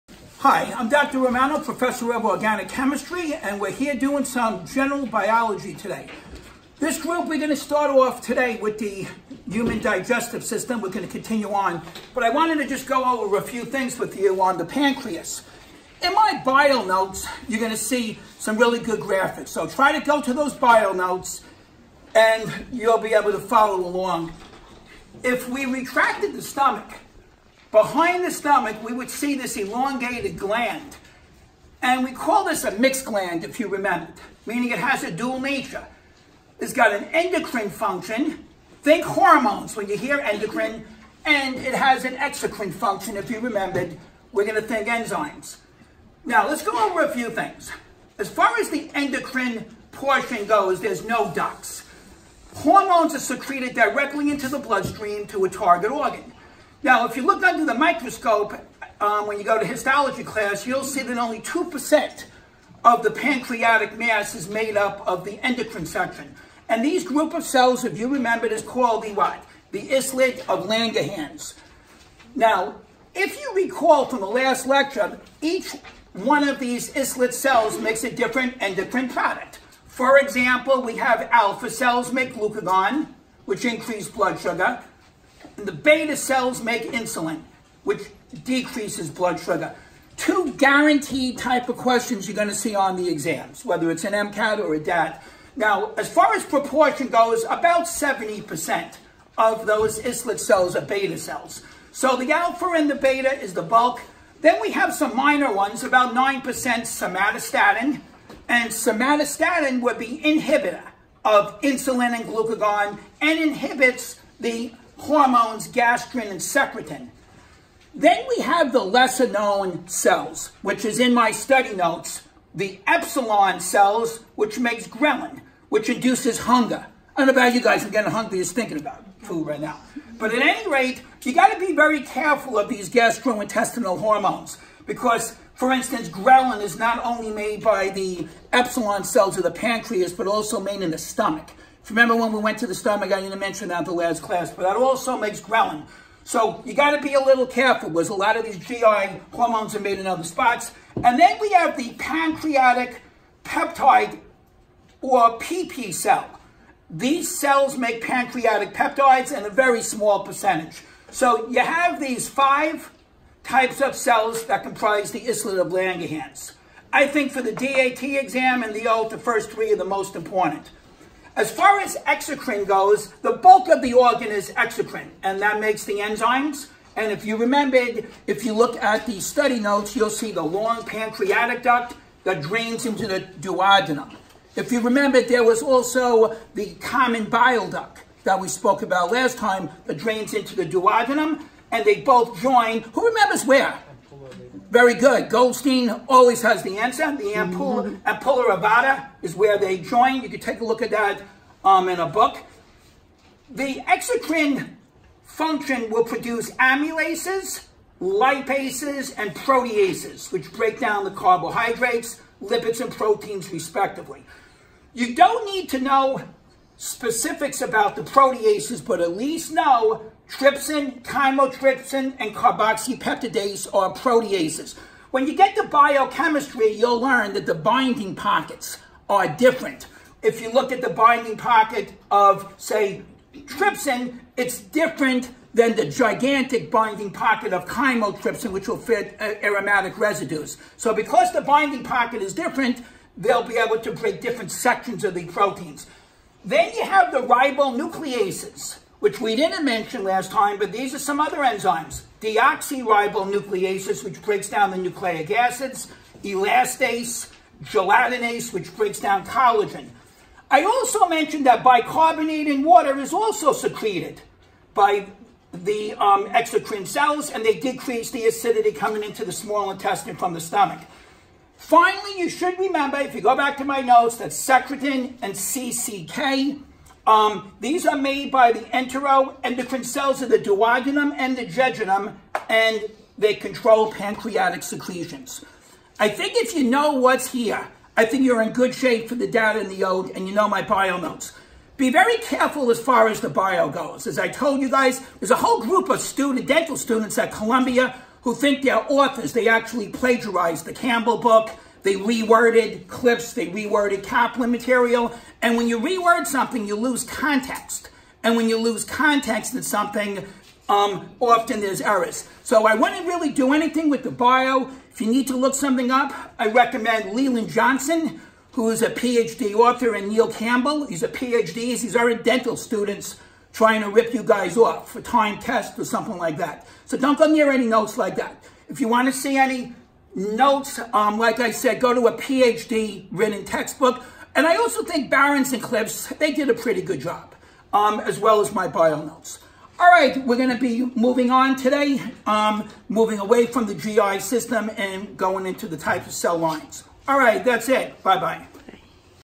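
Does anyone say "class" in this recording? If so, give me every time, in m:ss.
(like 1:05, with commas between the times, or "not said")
1:00, 2:24.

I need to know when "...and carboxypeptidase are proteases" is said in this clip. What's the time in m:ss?
3:42.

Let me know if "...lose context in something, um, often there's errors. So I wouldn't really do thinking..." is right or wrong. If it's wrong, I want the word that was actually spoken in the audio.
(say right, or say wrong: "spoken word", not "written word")
wrong: "anything", not "thinking".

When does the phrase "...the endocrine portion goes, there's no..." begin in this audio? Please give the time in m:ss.
0:48.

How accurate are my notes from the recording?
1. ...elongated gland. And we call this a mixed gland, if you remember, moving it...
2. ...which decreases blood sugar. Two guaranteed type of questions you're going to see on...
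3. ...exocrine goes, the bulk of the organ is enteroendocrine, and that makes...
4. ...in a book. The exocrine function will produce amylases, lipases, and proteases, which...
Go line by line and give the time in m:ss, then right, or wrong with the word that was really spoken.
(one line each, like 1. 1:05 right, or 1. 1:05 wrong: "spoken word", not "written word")
1. 0:29 wrong: "meaning", not "moving"
2. 1:27 right
3. 2:52 wrong: "exocrine", not "enteroendocrine"
4. 3:21 right.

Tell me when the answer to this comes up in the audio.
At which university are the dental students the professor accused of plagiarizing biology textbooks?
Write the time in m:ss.
4:57.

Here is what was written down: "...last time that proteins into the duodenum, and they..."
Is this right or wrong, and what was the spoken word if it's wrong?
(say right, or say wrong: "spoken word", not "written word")
wrong: "drains", not "proteins".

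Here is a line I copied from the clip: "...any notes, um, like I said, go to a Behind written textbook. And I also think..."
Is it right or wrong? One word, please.
wrong.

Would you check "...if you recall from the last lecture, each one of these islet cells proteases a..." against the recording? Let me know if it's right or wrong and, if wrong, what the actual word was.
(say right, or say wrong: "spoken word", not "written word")
wrong: "makes", not "proteases".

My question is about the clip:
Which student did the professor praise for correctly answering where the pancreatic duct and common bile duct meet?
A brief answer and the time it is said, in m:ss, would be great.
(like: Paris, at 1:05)
Goldstein, at 3:15.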